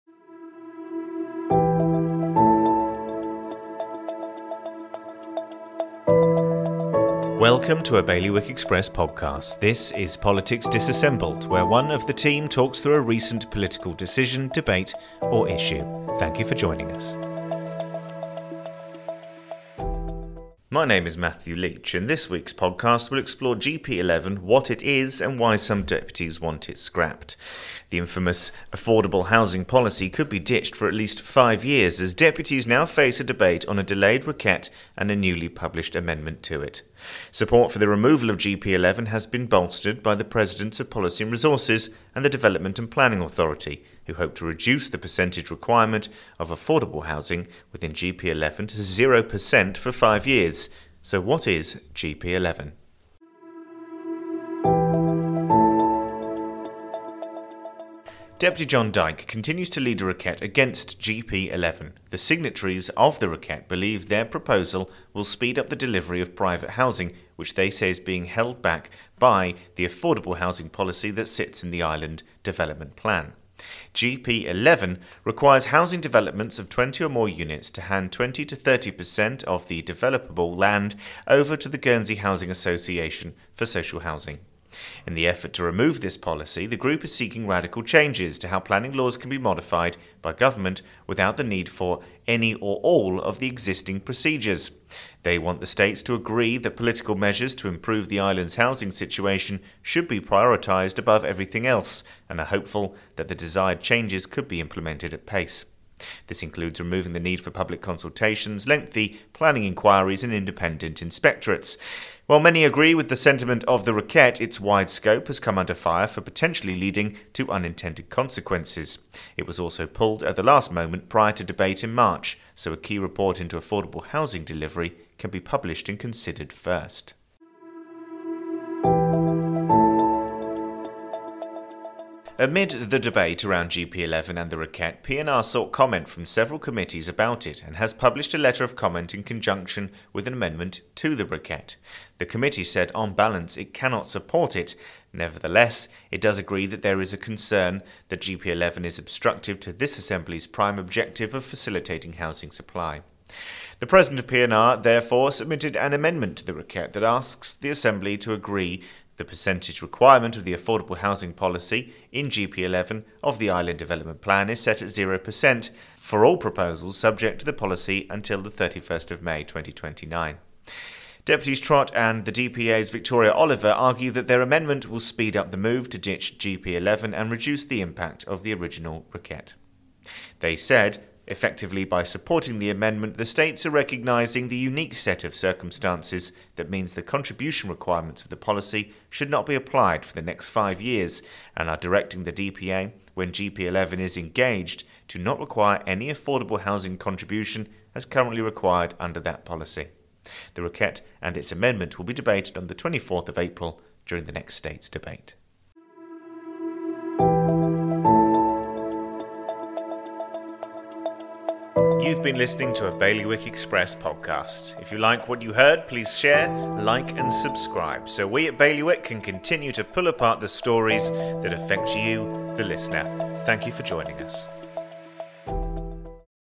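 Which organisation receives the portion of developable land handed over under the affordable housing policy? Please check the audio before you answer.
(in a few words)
Guernsey Housing Association.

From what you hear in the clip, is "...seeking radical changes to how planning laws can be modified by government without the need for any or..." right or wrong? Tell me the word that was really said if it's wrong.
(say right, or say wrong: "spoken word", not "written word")
right.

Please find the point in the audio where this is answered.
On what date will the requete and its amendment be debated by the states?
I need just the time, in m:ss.
3:22.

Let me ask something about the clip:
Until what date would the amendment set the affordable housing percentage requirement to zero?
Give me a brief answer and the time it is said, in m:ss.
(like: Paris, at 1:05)
31 May 2029, at 2:48.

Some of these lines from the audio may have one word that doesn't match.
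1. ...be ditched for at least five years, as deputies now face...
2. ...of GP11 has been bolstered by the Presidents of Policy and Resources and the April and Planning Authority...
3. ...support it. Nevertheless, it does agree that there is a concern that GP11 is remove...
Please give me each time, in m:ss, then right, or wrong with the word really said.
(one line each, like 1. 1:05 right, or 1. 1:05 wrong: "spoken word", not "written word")
1. 0:30 right
2. 0:38 wrong: "Development", not "April"
3. 2:24 wrong: "obstructive", not "remove".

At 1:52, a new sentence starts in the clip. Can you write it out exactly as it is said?
While many agree with the sentiment of the Requete, its wide scope has come under fire for potentially leading to unintended consequences.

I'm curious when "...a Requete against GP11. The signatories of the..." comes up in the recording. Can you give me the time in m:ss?
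1:00.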